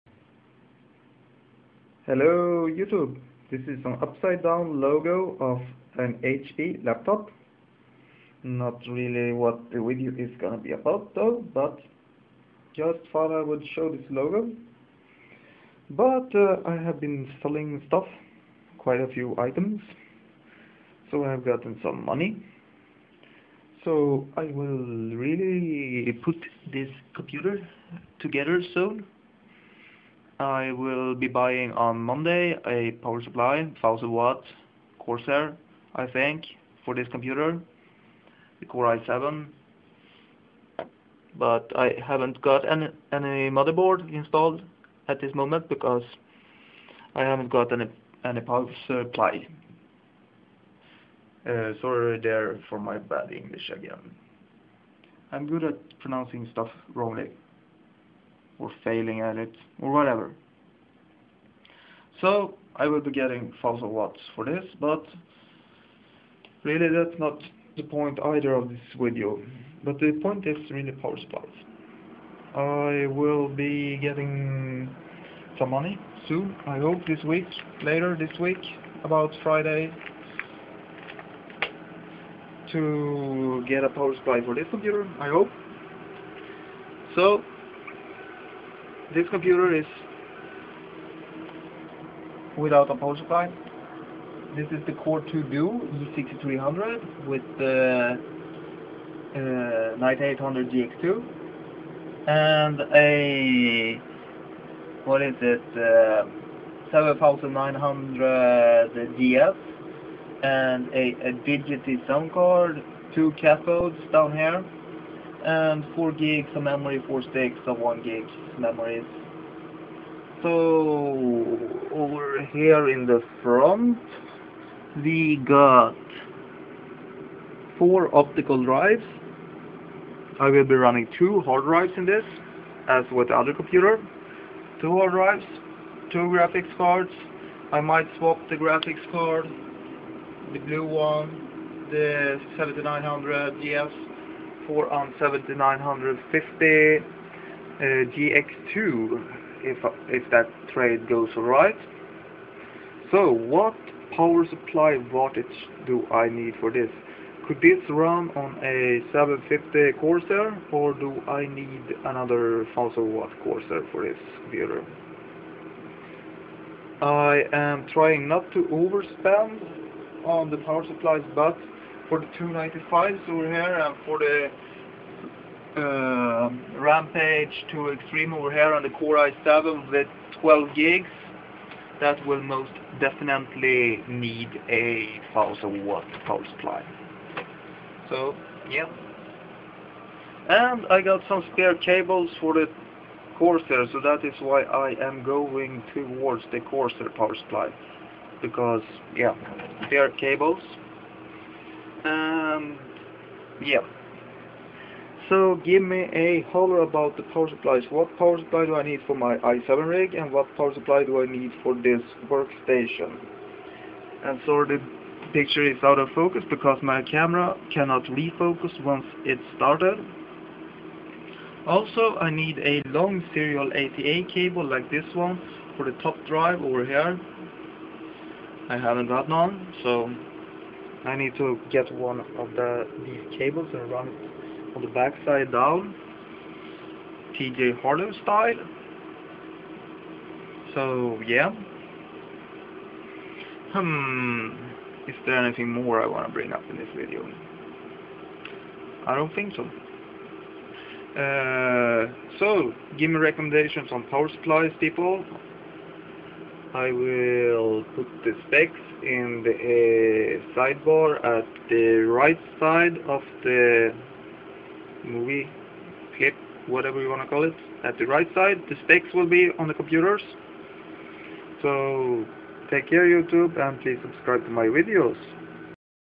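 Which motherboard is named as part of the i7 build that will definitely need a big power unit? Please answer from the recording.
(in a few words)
Rampage 2 Extreme.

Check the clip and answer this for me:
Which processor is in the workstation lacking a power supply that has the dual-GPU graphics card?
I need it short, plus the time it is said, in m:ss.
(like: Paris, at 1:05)
Core 2 Duo E6300, at 1:34.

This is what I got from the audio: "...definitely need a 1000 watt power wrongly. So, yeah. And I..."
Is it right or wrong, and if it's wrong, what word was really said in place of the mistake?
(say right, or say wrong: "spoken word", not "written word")
wrong: "supply", not "wrongly".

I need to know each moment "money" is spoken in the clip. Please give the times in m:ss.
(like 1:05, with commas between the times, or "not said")
0:22, 1:15.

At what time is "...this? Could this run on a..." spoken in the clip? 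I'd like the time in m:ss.
2:36.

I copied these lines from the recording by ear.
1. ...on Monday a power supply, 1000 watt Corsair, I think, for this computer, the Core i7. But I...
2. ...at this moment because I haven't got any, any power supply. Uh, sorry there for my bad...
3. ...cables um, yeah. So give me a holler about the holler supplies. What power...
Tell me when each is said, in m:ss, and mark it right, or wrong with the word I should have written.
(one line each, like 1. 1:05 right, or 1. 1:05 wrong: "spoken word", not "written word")
1. 0:31 right
2. 0:45 right
3. 3:20 wrong: "power", not "holler".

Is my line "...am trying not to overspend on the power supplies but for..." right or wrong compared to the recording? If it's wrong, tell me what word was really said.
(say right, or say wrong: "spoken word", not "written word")
right.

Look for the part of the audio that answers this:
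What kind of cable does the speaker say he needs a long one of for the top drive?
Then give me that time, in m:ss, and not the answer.
3:43.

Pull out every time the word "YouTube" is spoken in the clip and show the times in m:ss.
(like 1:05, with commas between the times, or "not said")
0:02, 4:33.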